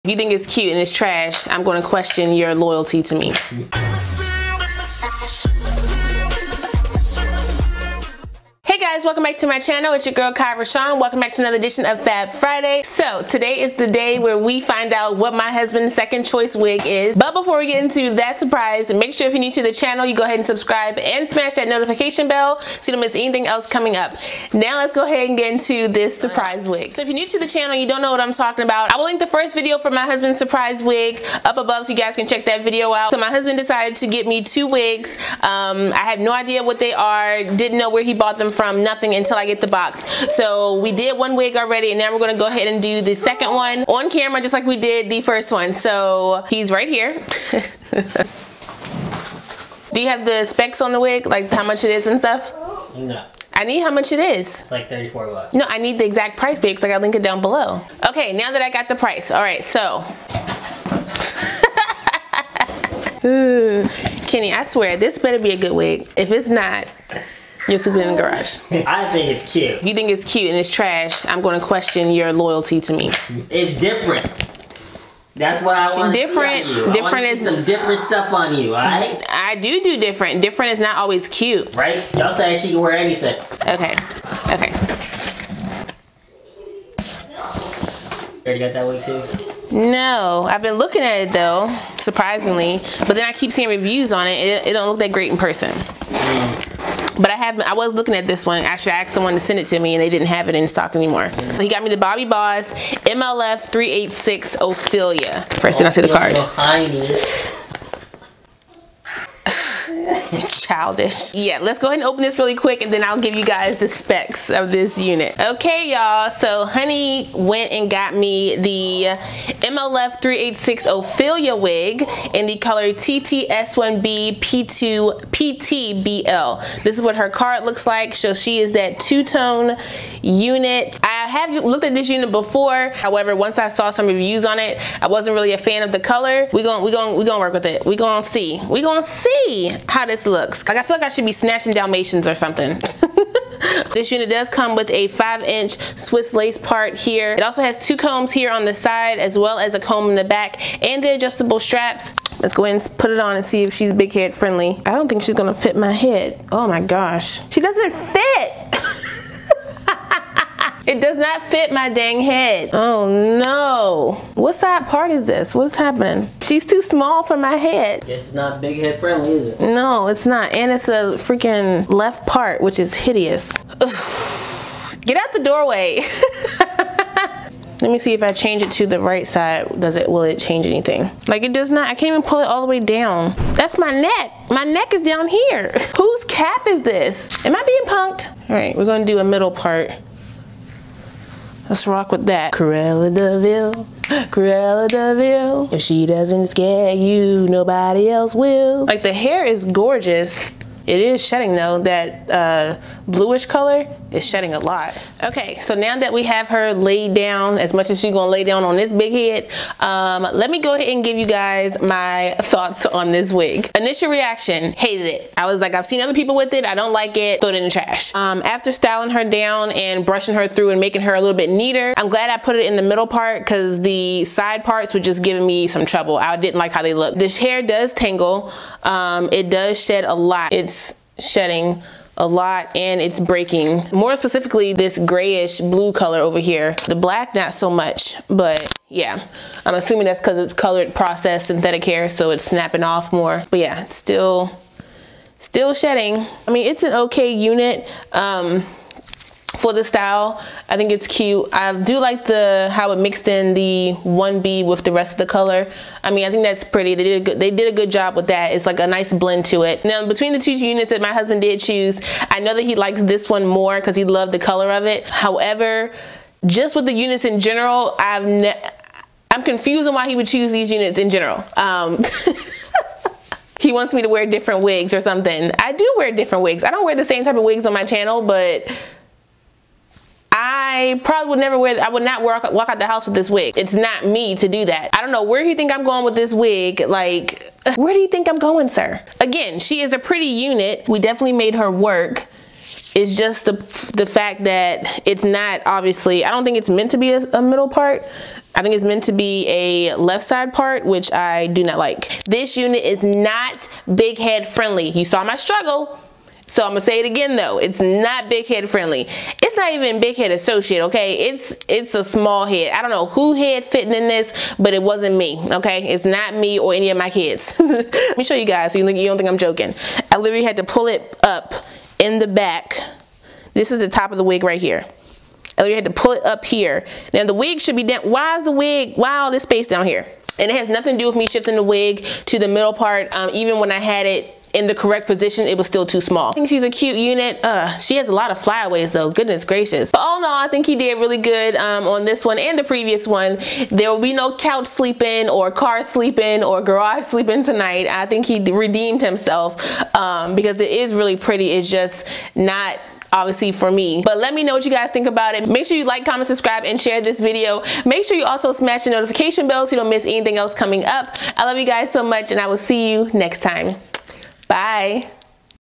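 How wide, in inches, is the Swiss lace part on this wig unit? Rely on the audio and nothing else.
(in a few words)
5 inches.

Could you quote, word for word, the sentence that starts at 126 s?
This is what her card looks like.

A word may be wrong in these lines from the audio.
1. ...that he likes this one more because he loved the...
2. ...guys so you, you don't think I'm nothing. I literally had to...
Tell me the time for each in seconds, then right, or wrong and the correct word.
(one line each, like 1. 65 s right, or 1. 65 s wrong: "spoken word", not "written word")
1. 262 s right
2. 318 s wrong: "joking", not "nothing".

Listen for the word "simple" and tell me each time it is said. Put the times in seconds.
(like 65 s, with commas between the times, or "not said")
not said.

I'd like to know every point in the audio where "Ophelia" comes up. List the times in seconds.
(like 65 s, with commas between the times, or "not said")
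104 s, 120 s.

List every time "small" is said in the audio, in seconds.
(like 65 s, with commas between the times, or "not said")
166 s, 312 s, 336 s.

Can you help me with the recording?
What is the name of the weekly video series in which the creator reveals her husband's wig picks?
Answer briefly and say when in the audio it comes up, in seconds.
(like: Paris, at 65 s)
Fab Friday, at 12 s.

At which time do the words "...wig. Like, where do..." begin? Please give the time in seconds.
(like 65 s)
286 s.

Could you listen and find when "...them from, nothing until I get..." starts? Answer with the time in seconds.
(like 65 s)
38 s.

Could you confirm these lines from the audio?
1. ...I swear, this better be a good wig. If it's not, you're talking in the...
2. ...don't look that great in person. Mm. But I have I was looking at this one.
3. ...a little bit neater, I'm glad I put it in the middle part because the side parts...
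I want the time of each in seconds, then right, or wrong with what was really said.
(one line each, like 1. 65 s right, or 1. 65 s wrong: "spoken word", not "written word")
1. 64 s wrong: "sleeping", not "talking"
2. 94 s right
3. 221 s right.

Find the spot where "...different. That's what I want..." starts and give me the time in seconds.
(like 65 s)
73 s.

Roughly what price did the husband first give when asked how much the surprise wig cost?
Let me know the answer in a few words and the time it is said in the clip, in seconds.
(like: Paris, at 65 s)
$34, at 54 s.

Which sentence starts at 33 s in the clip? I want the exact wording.
So my husband decided to get me two wigs.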